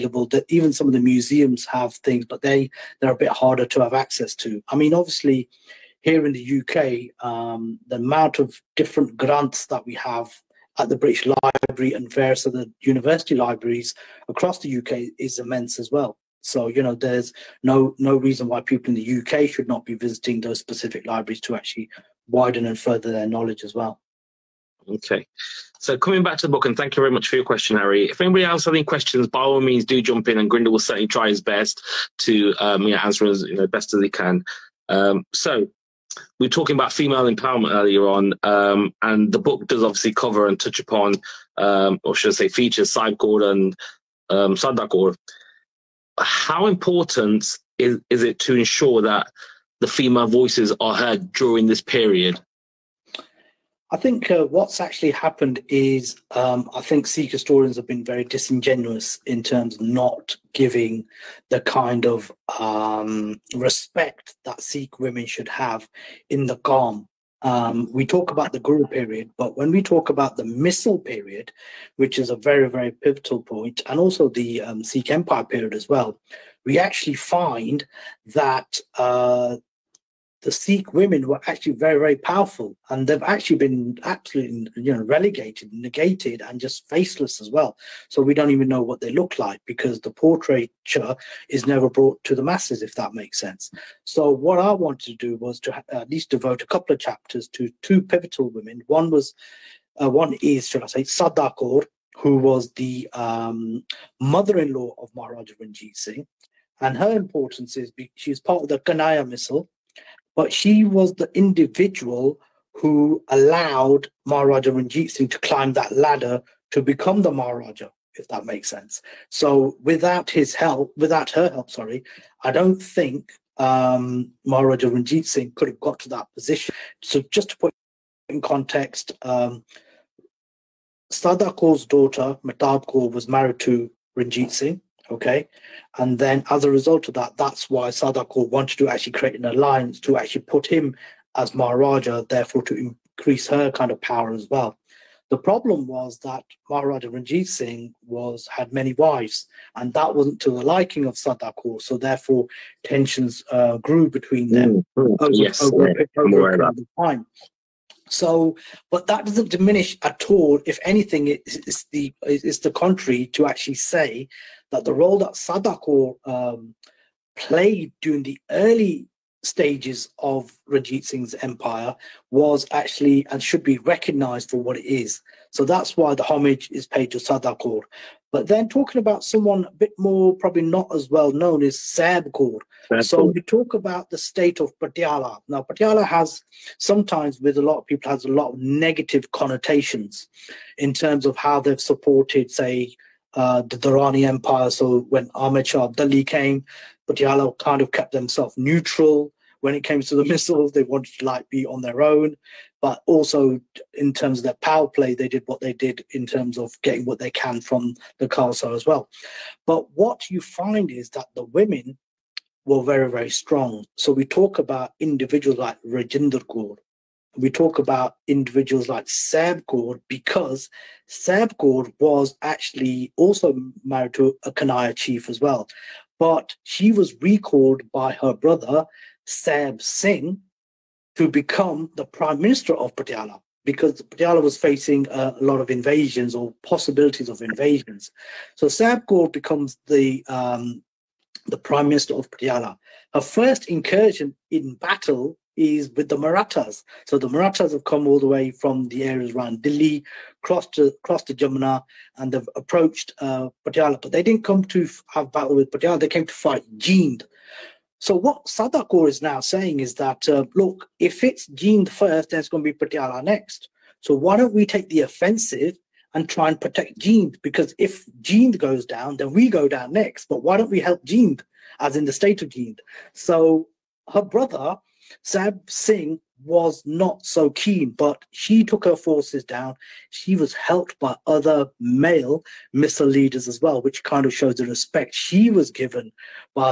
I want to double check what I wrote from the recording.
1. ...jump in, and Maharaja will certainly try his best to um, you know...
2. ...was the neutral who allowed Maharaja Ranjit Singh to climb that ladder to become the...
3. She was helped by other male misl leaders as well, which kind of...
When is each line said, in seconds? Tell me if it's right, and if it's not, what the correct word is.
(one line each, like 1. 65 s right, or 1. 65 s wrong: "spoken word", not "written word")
1. 30 s wrong: "Gurinder", not "Maharaja"
2. 110 s wrong: "individual", not "neutral"
3. 280 s right.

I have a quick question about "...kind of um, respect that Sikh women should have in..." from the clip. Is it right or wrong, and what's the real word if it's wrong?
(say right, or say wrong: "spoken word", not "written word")
right.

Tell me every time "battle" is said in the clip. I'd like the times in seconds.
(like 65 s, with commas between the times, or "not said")
244 s, 255 s.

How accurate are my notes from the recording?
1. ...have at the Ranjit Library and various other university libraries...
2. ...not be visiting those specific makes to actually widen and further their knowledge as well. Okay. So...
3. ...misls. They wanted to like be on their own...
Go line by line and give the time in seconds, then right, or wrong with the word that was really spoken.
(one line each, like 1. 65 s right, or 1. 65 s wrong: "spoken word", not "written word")
1. 9 s wrong: "British", not "Ranjit"
2. 19 s wrong: "libraries", not "makes"
3. 200 s right.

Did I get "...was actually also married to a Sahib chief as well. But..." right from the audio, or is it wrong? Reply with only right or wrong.
wrong.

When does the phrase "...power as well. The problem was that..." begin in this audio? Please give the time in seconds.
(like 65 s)
144 s.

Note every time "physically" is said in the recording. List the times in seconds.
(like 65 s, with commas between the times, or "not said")
not said.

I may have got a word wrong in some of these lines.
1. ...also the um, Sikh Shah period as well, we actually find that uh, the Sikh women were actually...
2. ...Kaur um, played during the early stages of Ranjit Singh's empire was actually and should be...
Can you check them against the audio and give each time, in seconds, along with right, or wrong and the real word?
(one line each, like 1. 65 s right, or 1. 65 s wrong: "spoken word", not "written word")
1. 73 s wrong: "Empire", not "Shah"
2. 165 s right.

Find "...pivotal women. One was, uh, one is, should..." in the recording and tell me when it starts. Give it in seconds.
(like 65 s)
98 s.